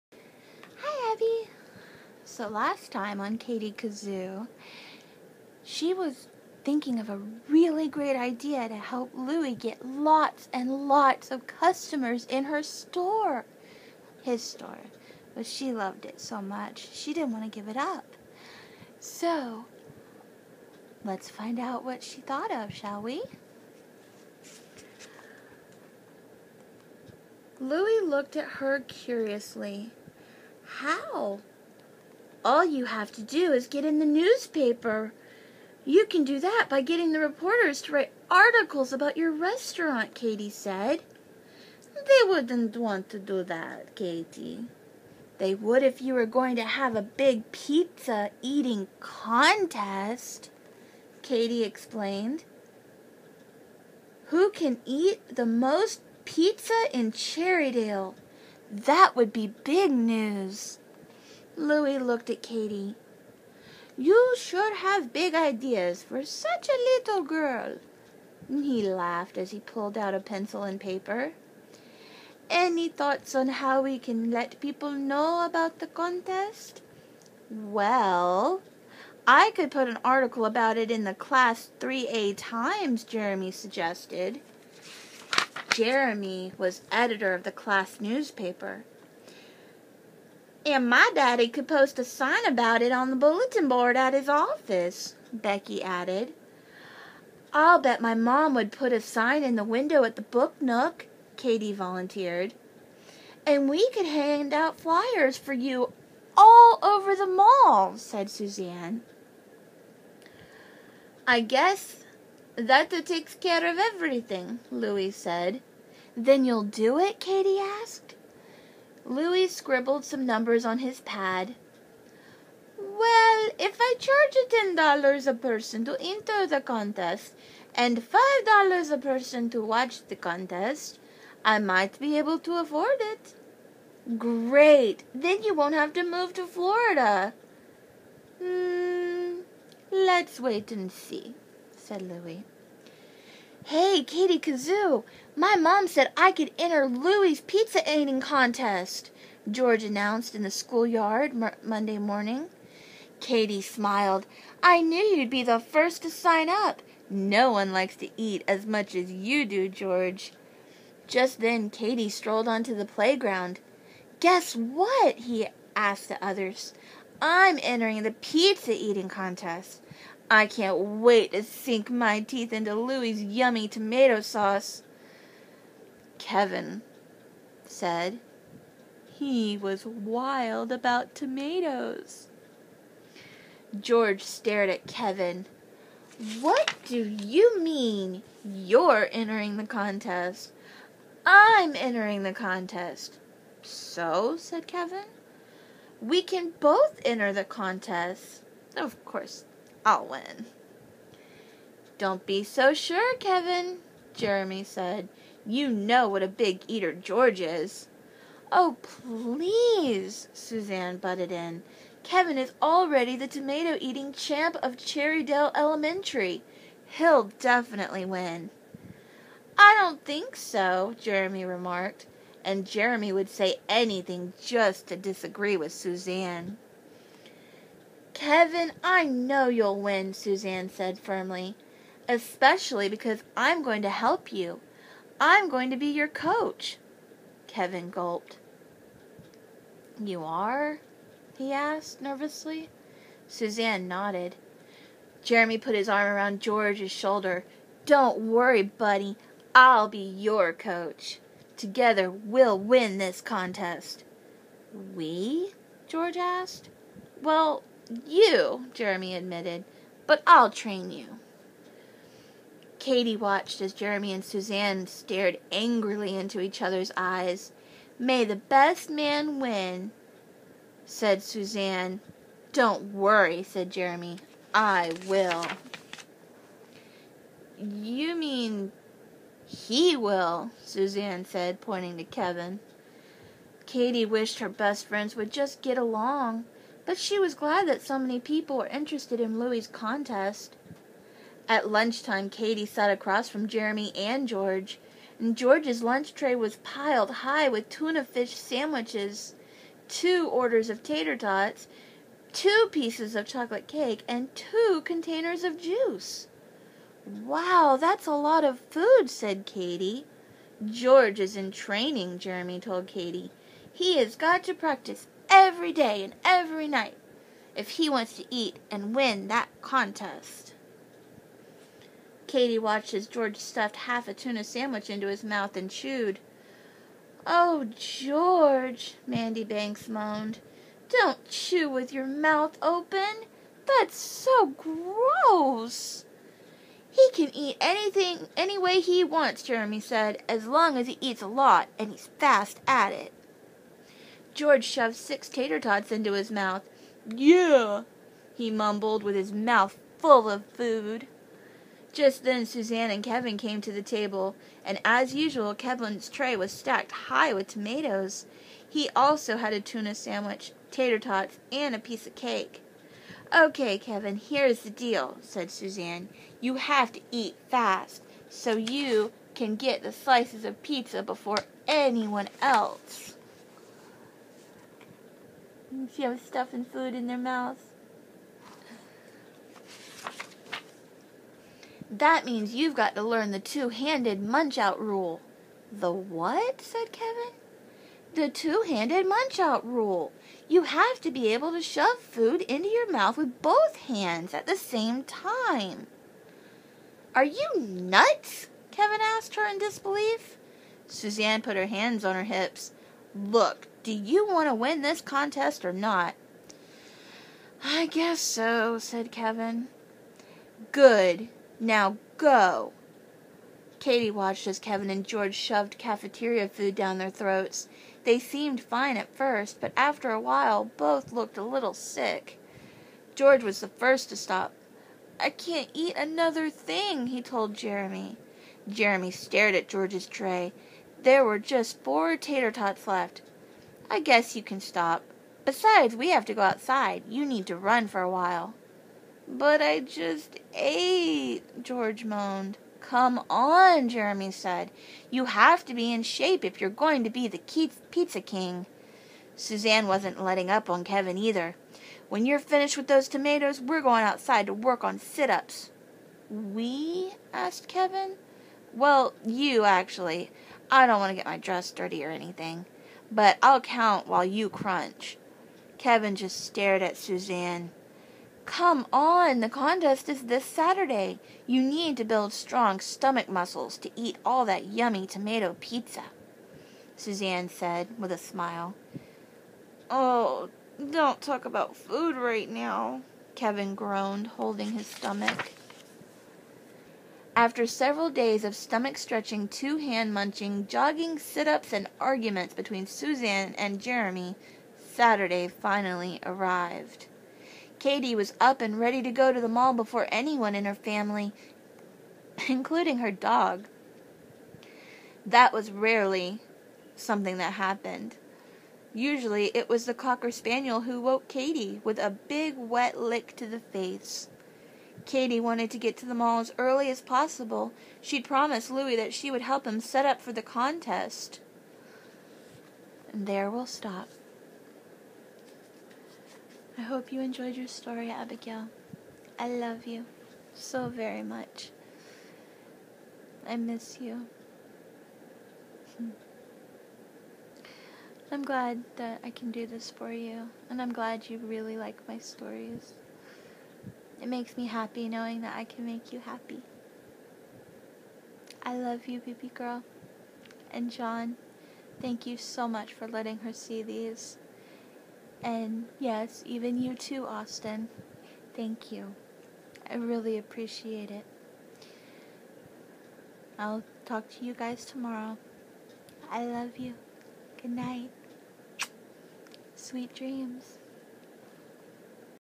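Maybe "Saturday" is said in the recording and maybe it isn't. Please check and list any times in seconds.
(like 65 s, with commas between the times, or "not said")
470 s, 494 s.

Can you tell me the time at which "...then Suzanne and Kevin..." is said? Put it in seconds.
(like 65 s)
352 s.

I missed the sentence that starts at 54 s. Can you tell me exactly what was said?
Who can eat the most pizza in Cherrydale?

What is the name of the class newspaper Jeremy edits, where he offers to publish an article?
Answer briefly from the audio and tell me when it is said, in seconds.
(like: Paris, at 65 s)
Class 3A Times, at 81 s.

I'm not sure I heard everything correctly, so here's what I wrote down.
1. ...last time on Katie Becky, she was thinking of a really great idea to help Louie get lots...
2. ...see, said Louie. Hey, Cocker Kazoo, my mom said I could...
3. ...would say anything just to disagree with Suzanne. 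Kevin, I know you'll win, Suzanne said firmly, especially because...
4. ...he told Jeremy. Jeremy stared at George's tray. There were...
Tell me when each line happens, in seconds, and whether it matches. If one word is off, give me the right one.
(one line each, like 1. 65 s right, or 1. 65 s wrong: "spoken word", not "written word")
1. 2 s wrong: "Kazoo", not "Becky"
2. 140 s wrong: "Katie", not "Cocker"
3. 223 s right
4. 427 s right.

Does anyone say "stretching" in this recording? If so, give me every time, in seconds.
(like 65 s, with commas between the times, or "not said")
488 s.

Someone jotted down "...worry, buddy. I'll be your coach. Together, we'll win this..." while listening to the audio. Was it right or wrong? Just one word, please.
right.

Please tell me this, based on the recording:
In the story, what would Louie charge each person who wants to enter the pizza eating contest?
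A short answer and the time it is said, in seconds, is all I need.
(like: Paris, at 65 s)
$10, at 124 s.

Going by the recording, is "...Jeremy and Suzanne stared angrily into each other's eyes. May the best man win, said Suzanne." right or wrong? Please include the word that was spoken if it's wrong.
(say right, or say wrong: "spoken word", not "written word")
right.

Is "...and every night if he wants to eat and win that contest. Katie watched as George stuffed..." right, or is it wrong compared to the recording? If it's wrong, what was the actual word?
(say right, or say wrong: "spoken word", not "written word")
right.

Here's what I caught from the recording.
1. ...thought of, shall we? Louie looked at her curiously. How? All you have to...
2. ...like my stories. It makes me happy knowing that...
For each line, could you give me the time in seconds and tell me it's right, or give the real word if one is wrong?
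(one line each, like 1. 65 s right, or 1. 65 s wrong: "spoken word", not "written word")
1. 22 s right
2. 541 s right.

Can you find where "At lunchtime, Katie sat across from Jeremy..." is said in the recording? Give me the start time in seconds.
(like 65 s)
291 s.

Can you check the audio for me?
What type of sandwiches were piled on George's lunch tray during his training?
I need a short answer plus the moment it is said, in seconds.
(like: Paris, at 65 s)
Tuna fish, at 297 s.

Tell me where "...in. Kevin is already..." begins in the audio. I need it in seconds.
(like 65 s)
211 s.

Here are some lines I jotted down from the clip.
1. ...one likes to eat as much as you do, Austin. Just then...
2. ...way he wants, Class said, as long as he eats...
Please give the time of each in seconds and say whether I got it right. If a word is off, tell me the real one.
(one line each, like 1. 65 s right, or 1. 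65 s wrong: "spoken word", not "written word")
1. 157 s wrong: "George", not "Austin"
2. 338 s wrong: "Jeremy", not "Class".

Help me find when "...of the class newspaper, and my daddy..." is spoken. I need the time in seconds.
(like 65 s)
87 s.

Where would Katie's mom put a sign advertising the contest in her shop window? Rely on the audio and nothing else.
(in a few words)
The Book Nook.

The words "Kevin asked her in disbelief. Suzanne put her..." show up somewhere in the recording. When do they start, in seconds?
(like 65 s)
398 s.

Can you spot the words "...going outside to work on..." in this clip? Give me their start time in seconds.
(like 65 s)
453 s.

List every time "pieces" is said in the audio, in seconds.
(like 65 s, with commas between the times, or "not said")
302 s, 361 s.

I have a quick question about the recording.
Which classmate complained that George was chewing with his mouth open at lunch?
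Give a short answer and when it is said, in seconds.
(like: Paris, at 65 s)
Mandy Banks, at 329 s.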